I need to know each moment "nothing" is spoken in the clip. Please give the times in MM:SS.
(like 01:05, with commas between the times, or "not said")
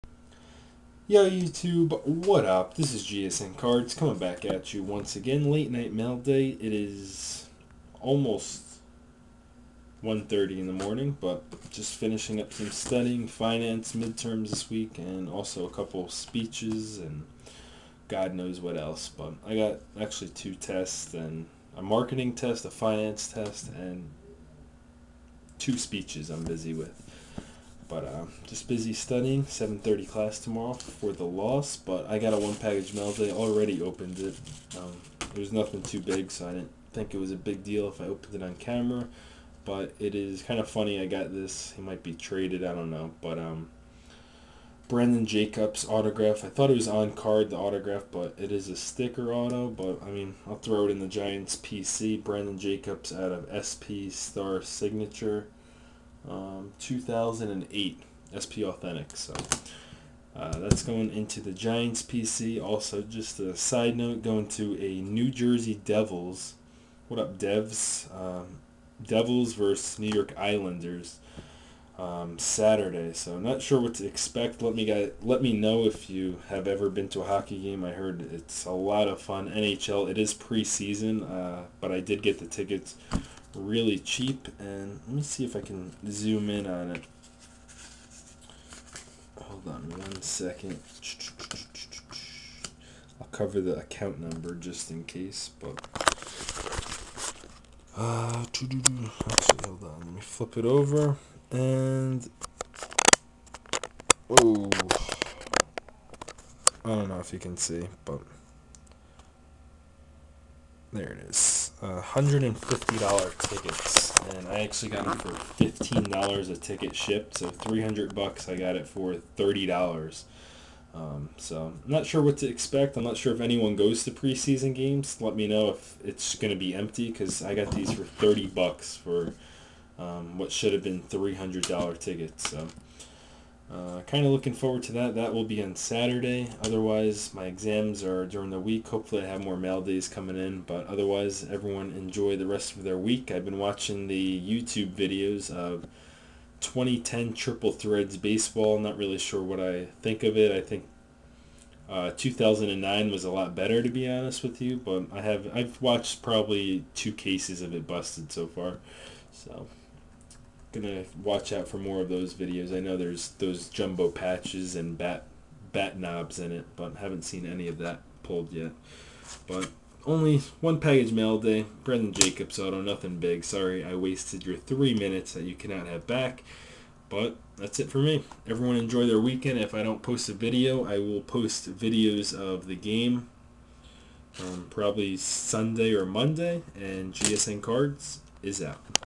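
00:35, 02:52.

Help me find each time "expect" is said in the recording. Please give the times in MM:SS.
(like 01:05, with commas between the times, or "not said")
01:14, 02:02.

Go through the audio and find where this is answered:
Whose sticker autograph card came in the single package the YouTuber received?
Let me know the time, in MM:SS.
00:52.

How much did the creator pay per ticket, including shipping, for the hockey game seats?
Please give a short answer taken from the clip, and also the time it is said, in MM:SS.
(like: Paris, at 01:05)
$15, at 01:55.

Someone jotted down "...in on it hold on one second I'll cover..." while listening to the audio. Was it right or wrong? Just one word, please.
right.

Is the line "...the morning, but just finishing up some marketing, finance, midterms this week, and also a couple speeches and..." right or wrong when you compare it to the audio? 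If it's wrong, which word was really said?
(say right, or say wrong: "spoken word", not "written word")
wrong: "studying", not "marketing".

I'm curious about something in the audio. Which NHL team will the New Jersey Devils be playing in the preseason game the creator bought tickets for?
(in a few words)
New York Islanders.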